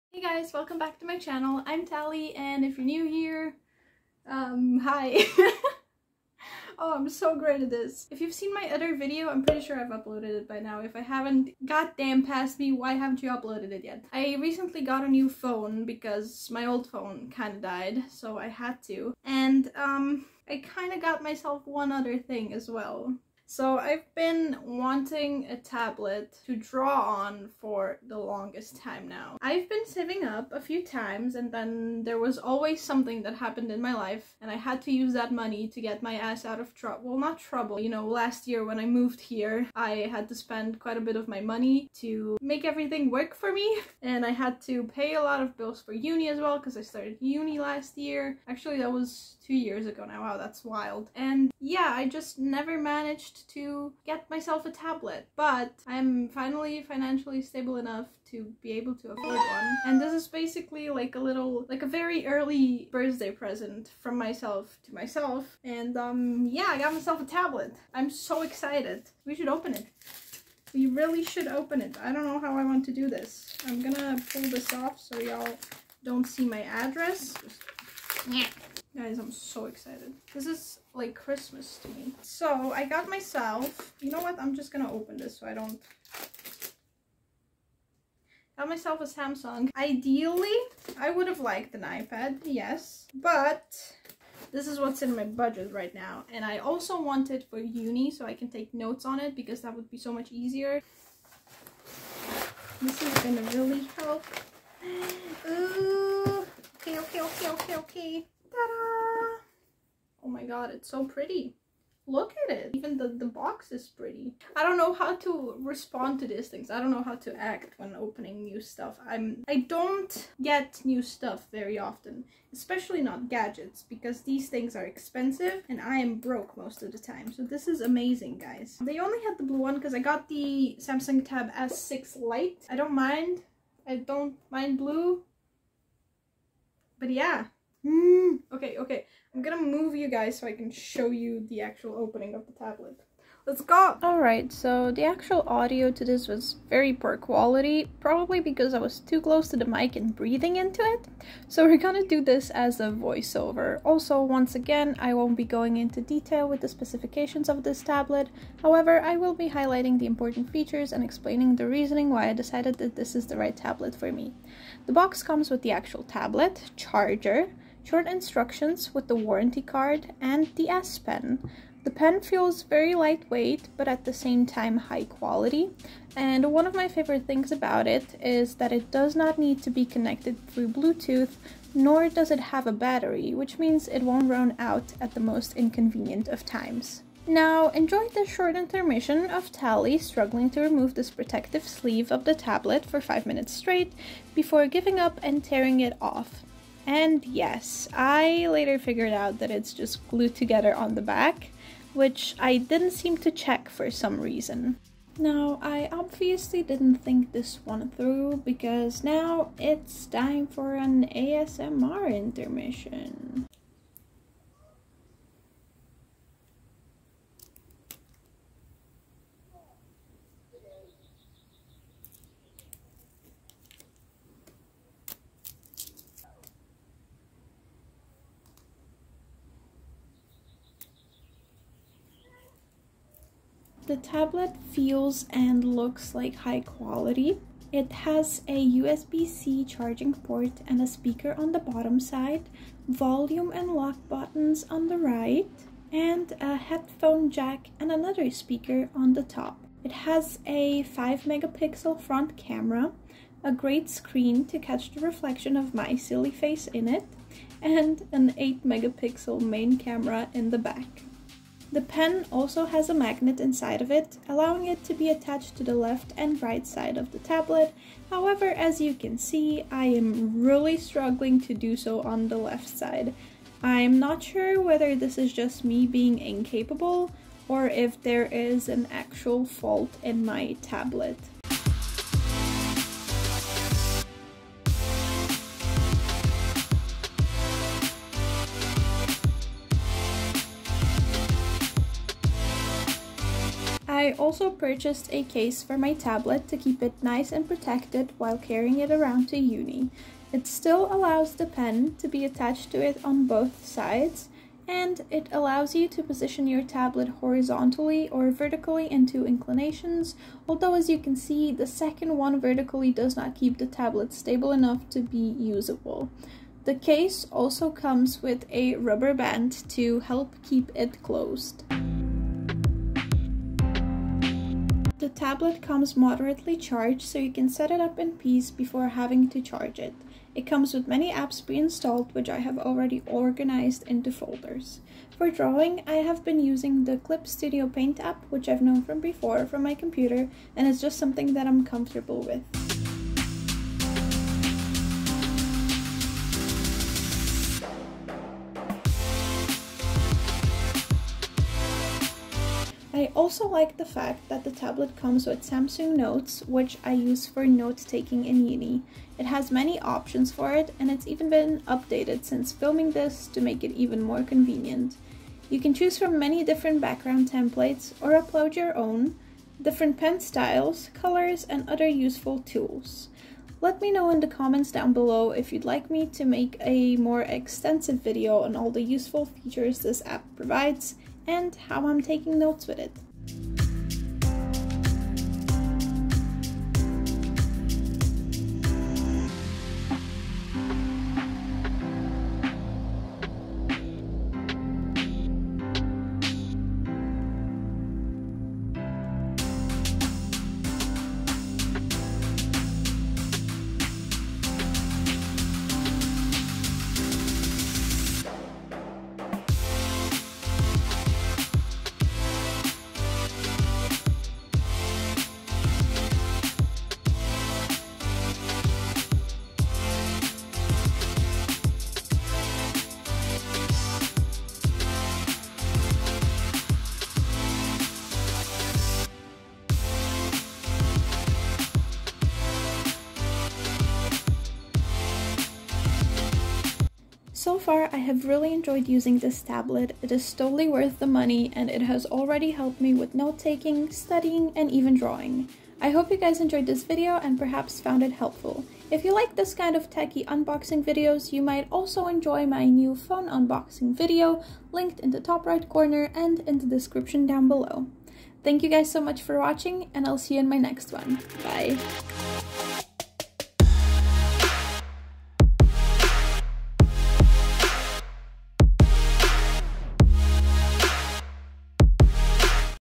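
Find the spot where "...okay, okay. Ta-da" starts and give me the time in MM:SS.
01:47.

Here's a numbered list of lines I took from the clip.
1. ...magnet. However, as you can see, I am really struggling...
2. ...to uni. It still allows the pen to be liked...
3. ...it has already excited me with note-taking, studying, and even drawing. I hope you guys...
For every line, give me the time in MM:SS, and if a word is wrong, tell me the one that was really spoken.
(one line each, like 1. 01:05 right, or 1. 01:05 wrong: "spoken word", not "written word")
1. 04:27 wrong: "tablet", not "magnet"
2. 04:59 wrong: "attached", not "liked"
3. 07:21 wrong: "helped", not "excited".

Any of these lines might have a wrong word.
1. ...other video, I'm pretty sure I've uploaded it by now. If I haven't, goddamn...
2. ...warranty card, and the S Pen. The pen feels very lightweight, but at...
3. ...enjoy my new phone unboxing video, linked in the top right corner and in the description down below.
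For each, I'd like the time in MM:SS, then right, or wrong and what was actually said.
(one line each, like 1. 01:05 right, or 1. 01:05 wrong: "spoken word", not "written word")
1. 00:08 right
2. 02:49 right
3. 07:32 right.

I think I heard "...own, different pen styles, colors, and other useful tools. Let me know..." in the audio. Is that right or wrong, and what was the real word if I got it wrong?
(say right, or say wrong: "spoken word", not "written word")
right.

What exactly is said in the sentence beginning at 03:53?
the tablet feels and looks like high quality.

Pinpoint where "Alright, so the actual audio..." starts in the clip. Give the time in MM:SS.
02:24.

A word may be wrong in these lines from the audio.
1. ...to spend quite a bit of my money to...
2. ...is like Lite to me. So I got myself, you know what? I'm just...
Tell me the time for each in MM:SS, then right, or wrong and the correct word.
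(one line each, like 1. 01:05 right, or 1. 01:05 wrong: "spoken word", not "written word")
1. 00:40 right
2. 01:20 wrong: "Christmas", not "Lite".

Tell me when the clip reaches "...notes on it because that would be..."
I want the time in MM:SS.
01:38.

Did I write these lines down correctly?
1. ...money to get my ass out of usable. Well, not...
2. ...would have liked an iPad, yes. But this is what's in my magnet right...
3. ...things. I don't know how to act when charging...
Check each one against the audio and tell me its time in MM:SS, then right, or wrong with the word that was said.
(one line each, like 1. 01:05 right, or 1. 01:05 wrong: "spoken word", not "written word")
1. 00:35 wrong: "trouble", not "usable"
2. 01:31 wrong: "budget", not "magnet"
3. 01:56 wrong: "opening", not "charging".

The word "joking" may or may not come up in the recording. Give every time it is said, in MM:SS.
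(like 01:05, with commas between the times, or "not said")
not said.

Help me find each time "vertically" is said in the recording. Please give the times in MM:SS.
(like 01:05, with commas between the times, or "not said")
05:08, 05:12.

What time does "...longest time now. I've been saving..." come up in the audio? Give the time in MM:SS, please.
00:28.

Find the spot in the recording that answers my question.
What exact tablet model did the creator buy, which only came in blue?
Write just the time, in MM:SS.
02:10.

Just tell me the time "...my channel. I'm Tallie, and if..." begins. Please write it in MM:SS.
00:01.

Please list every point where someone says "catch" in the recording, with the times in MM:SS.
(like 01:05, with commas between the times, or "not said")
04:14.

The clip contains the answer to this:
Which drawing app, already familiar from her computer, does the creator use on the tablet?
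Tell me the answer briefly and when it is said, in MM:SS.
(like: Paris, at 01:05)
Clip Studio Paint, at 05:36.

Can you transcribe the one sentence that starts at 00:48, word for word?
Actually, that was two years ago now.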